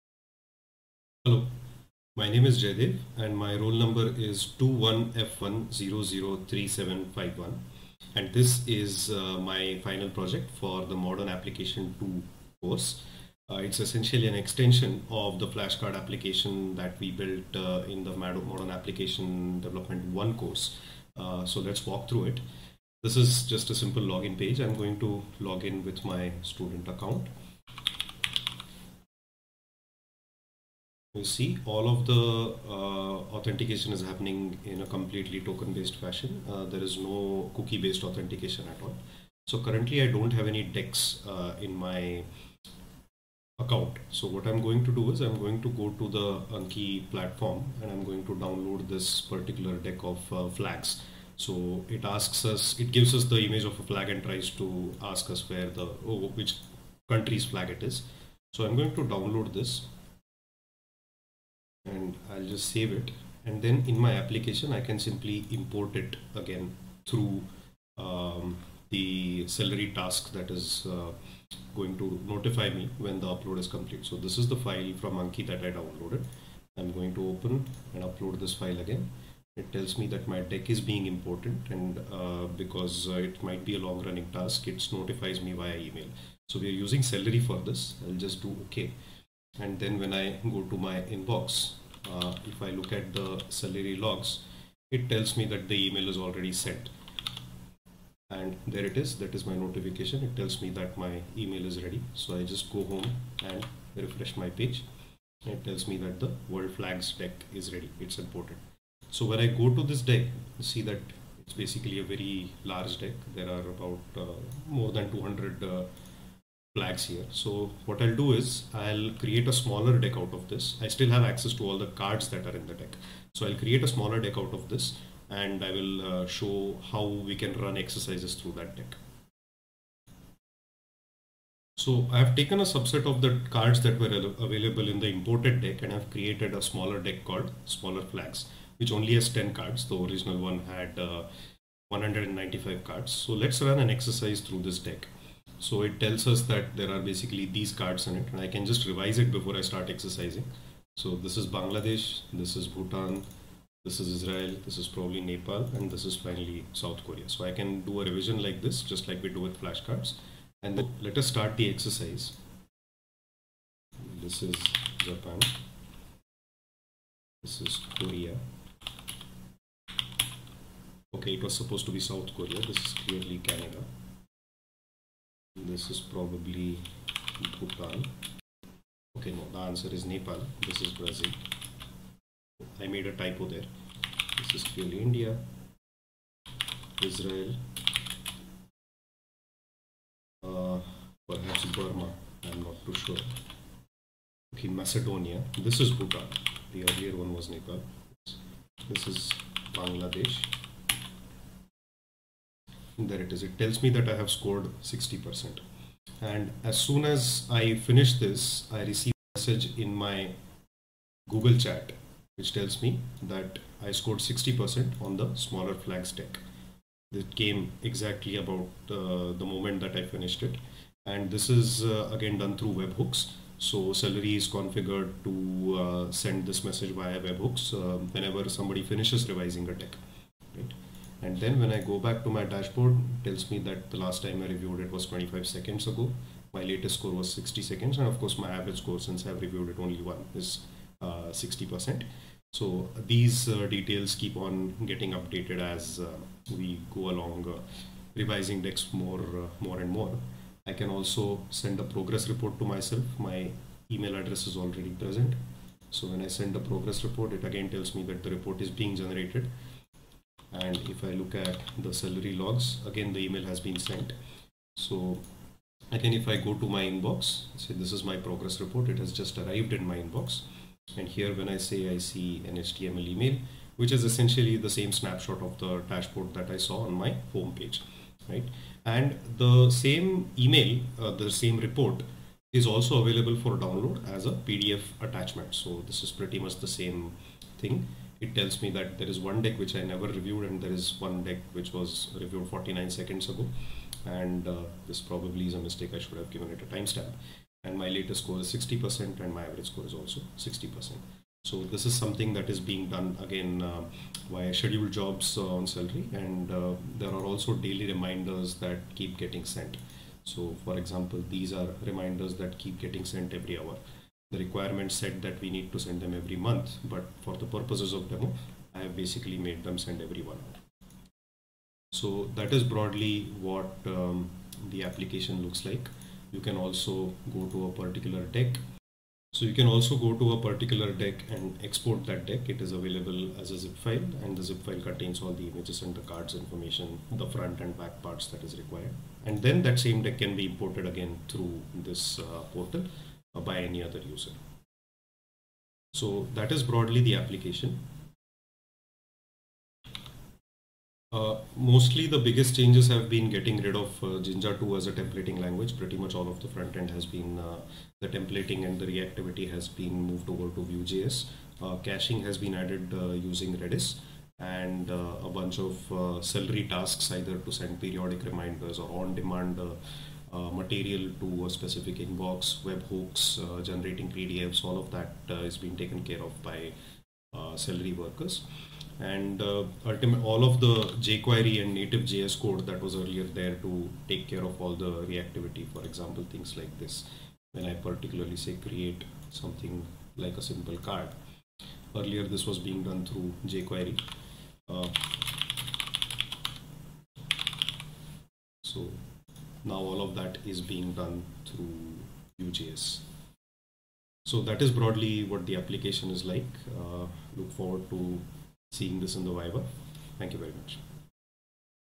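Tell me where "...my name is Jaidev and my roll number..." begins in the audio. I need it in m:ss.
0:02.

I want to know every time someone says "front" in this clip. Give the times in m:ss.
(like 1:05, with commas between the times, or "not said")
5:37, 5:56.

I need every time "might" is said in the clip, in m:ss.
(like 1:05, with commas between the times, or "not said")
1:23.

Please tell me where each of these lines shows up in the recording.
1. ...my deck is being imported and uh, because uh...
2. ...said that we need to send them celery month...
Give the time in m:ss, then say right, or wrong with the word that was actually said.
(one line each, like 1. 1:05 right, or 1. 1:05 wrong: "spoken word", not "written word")
1. 1:20 right
2. 5:14 wrong: "every", not "celery".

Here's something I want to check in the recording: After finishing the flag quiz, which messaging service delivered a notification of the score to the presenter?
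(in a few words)
Google Chat.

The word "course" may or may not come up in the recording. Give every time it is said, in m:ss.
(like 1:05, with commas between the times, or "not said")
0:12, 0:20, 3:58.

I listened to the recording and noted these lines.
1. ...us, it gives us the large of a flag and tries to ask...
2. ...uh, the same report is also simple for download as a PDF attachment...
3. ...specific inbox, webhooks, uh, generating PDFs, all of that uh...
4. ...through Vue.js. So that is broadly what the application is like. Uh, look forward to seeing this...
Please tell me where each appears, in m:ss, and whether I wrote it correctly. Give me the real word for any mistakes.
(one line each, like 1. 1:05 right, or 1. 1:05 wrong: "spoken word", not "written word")
1. 0:52 wrong: "image", not "large"
2. 4:40 wrong: "available", not "simple"
3. 6:11 right
4. 6:41 right.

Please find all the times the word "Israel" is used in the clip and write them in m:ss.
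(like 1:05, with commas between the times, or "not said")
2:34, 3:07.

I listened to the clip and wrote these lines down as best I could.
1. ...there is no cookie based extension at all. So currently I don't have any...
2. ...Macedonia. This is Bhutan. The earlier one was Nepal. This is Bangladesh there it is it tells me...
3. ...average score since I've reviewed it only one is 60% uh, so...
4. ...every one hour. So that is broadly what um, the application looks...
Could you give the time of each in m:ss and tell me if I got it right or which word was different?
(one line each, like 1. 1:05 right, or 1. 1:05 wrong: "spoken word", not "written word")
1. 0:36 wrong: "authentication", not "extension"
2. 3:14 right
3. 3:58 right
4. 5:20 right.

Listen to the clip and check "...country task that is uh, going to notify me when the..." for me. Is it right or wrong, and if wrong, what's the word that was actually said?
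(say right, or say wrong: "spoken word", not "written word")
wrong: "celery", not "country".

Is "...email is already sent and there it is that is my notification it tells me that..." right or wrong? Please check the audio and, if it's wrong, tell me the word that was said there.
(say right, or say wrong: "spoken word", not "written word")
right.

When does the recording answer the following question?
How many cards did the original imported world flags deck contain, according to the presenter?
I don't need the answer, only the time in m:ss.
2:21.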